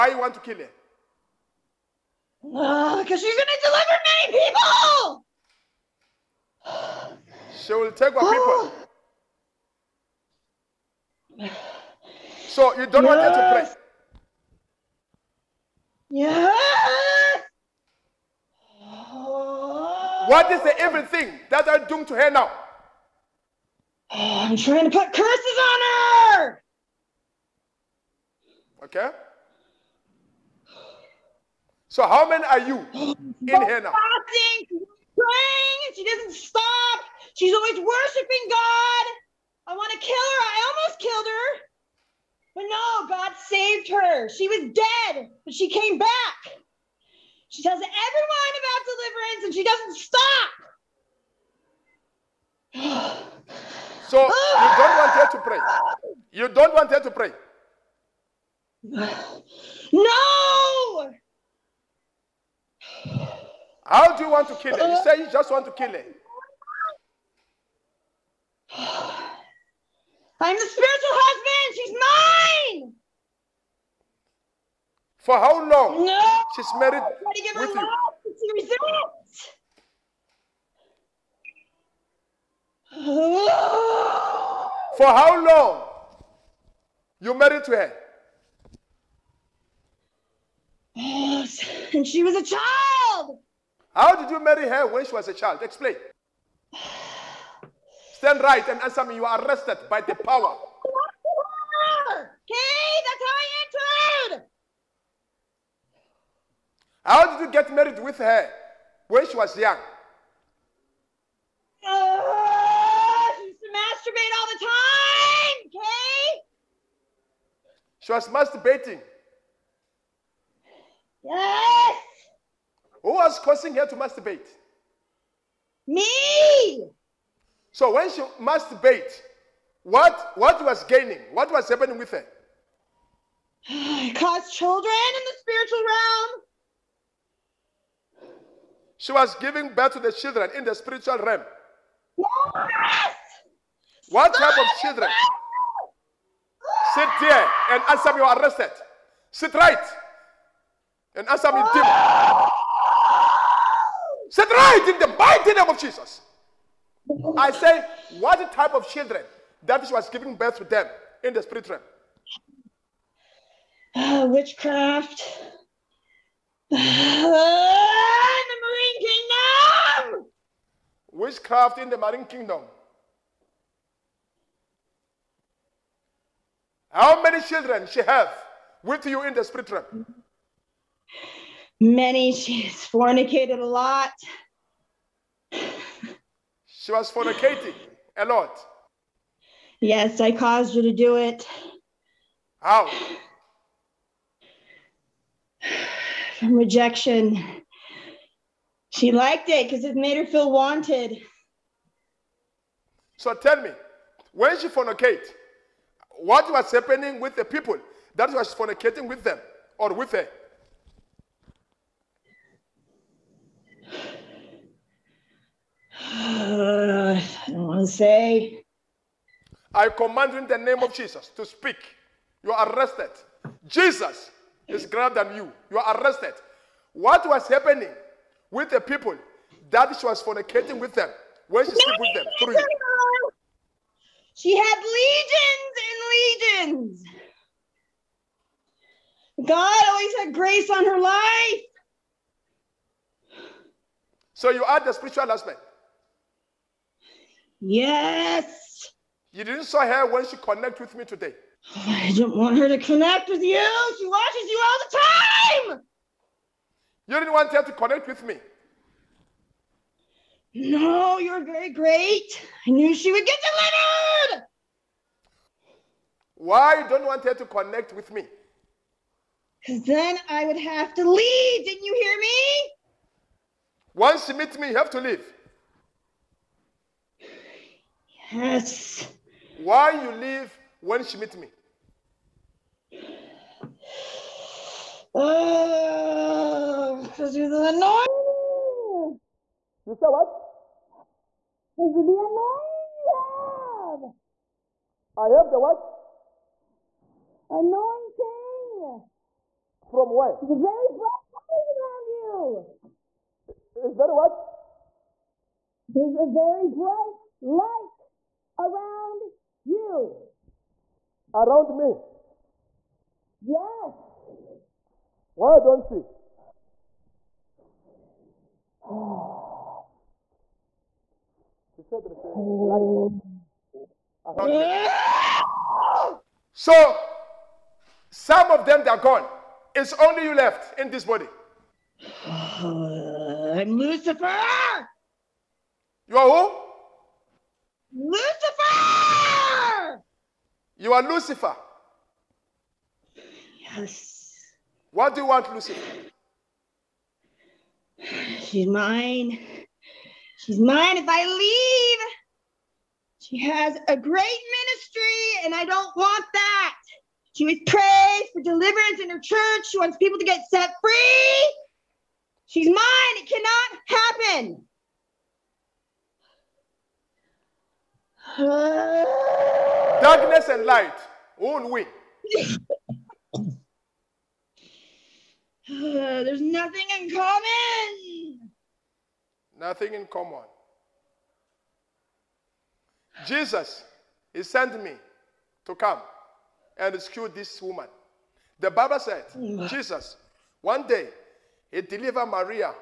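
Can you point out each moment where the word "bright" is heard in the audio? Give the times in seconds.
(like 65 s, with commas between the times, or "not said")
300 s, 306 s.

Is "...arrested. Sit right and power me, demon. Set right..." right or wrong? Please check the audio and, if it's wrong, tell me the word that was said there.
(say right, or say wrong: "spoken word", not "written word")
wrong: "answer", not "power".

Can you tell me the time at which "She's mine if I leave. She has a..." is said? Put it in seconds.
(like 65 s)
350 s.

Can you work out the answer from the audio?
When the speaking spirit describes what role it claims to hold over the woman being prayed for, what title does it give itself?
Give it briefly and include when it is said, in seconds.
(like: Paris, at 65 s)
Spiritual husband, at 70 s.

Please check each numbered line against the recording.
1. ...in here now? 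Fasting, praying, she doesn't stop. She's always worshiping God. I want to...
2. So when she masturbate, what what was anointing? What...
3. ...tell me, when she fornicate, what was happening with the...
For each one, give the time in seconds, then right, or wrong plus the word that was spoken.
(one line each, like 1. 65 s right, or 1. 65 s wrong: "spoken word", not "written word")
1. 32 s right
2. 127 s wrong: "gaining", not "anointing"
3. 203 s right.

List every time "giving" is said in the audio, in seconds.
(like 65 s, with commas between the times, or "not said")
139 s, 160 s.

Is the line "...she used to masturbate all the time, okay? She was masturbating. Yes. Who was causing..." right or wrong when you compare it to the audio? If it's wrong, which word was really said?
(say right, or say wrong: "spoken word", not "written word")
right.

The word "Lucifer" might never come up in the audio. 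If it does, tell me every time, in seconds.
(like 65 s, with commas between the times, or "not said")
333 s, 341 s, 345 s.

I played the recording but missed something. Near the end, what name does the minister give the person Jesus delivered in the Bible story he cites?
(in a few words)
Maria.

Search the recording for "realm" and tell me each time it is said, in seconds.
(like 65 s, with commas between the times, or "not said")
135 s, 141 s, 161 s, 179 s.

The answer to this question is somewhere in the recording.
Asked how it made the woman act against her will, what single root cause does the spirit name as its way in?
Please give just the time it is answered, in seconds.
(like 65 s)
196 s.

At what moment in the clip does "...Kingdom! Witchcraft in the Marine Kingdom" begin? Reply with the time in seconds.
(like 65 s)
170 s.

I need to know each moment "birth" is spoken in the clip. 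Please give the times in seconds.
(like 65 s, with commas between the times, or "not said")
139 s, 160 s.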